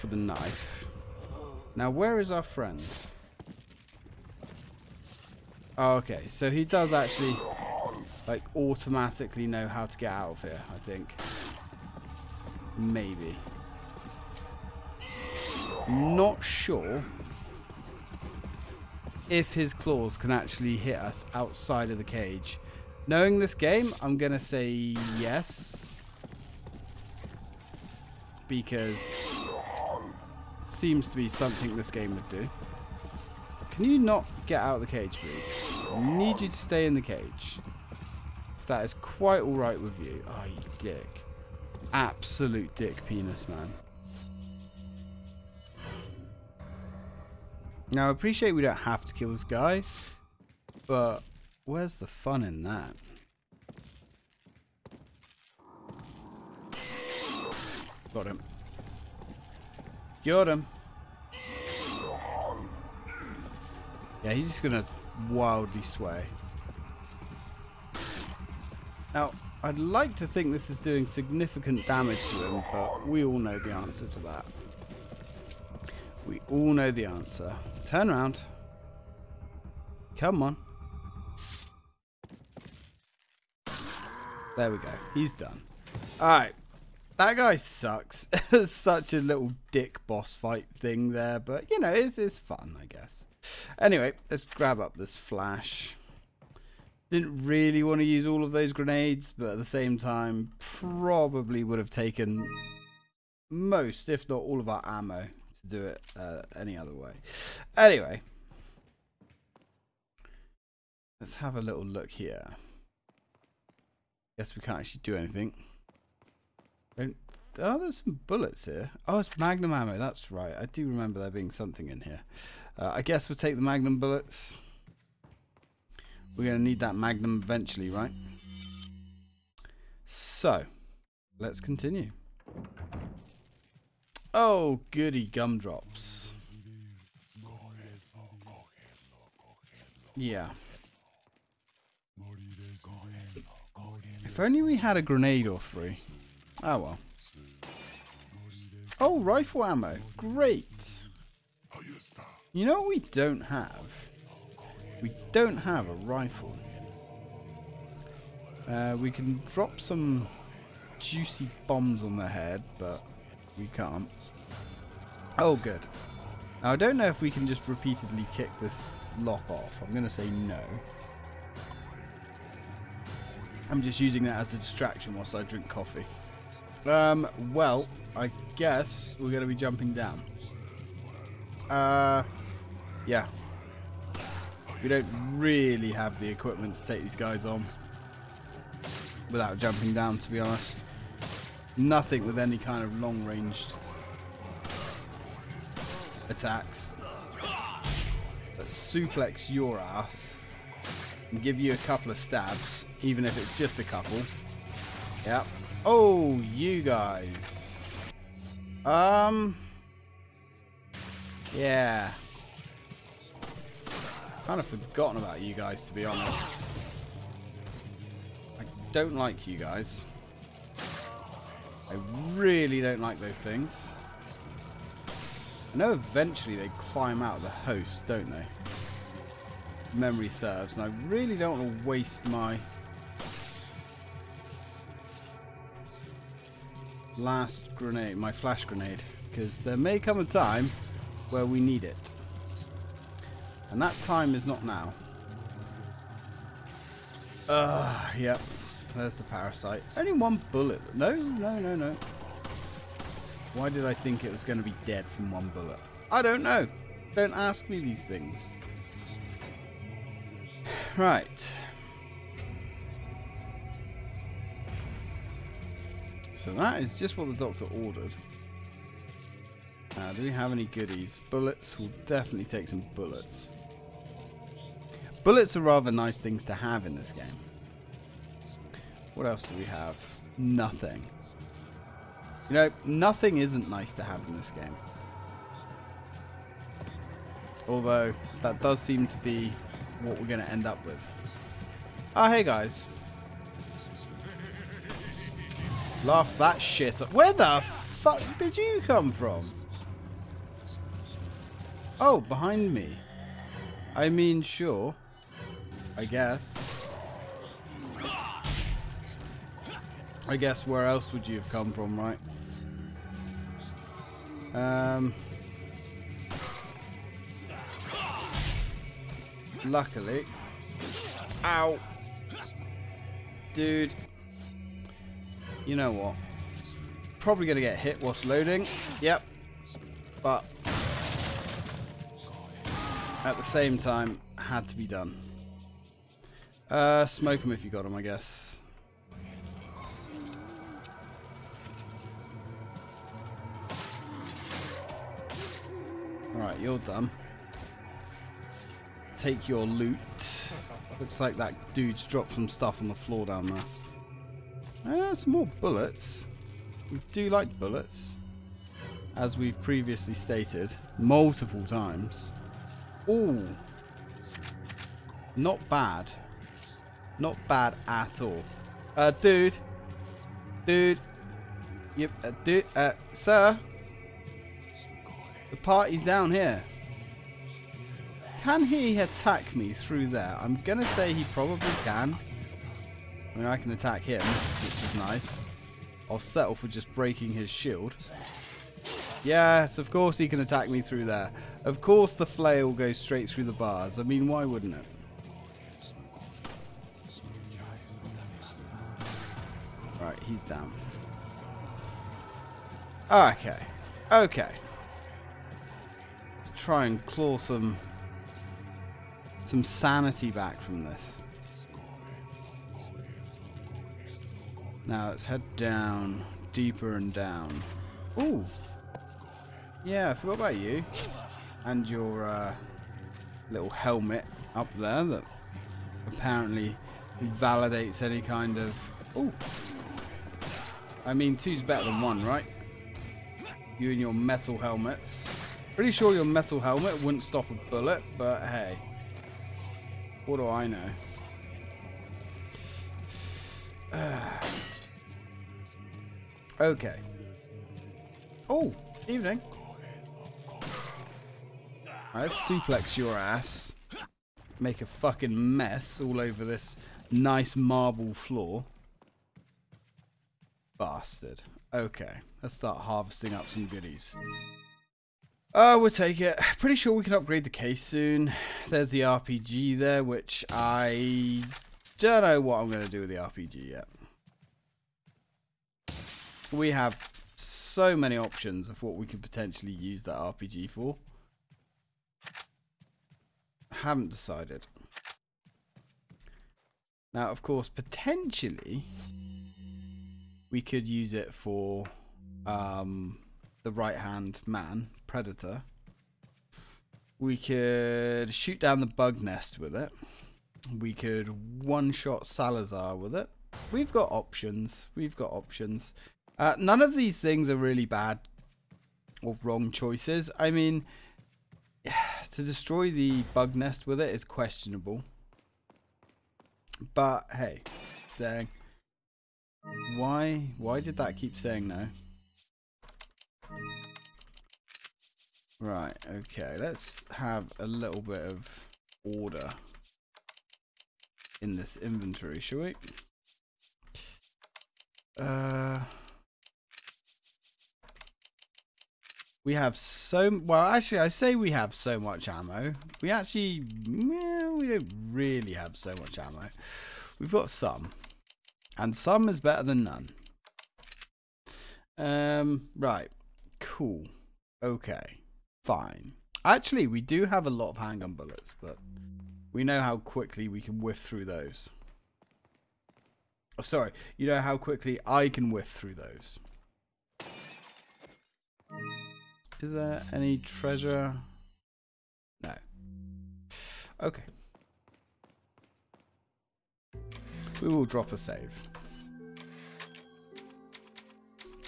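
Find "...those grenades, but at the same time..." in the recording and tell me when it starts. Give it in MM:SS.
01:38.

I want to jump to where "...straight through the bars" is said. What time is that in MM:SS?
06:32.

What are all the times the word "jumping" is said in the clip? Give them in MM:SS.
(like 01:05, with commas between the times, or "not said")
02:59, 03:09.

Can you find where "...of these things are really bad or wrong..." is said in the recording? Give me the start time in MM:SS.
08:26.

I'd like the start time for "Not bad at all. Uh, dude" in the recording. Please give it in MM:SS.
06:07.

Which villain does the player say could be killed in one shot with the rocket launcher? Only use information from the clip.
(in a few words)
Salazar.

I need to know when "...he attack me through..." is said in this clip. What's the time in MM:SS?
06:18.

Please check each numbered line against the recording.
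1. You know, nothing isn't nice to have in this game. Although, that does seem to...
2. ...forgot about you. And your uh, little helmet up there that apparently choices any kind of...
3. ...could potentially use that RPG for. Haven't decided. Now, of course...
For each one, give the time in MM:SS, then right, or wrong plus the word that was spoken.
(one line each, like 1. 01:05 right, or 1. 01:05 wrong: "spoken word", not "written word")
1. 04:42 right
2. 07:00 wrong: "validates", not "choices"
3. 07:59 right.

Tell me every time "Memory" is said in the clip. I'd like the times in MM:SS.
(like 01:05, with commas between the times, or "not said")
03:49.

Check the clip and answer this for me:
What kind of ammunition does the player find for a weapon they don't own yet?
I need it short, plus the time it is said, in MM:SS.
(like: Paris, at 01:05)
Rifle ammo, at 02:29.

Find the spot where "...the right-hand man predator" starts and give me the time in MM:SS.
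08:13.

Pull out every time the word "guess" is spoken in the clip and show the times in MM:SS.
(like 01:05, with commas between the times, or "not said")
01:32, 01:54, 02:03, 02:58, 05:06, 05:10, 05:38.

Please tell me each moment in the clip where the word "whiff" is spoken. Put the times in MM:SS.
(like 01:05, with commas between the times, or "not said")
09:20, 09:25.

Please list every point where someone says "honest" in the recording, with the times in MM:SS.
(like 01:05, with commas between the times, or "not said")
03:10, 03:36.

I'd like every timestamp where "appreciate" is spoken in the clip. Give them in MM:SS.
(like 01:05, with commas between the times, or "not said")
00:48.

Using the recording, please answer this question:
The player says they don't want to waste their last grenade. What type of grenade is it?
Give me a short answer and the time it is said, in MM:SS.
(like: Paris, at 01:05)
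Flash grenade, at 03:58.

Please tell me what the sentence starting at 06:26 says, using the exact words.
I'll settle for just breaking his shield.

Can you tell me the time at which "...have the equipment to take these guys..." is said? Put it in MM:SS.
03:05.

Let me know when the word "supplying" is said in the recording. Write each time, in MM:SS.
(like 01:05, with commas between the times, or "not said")
not said.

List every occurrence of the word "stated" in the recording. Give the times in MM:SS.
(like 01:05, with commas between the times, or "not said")
06:00.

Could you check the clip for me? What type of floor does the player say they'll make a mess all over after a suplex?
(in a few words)
Marble floor.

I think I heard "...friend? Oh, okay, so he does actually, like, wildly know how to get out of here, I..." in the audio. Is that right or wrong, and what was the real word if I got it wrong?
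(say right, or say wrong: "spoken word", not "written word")
wrong: "automatically", not "wildly".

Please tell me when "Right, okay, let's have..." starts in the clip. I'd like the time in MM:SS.
08:45.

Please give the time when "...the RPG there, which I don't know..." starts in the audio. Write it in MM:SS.
07:48.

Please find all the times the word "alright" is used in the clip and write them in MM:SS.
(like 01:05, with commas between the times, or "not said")
00:39, 01:26.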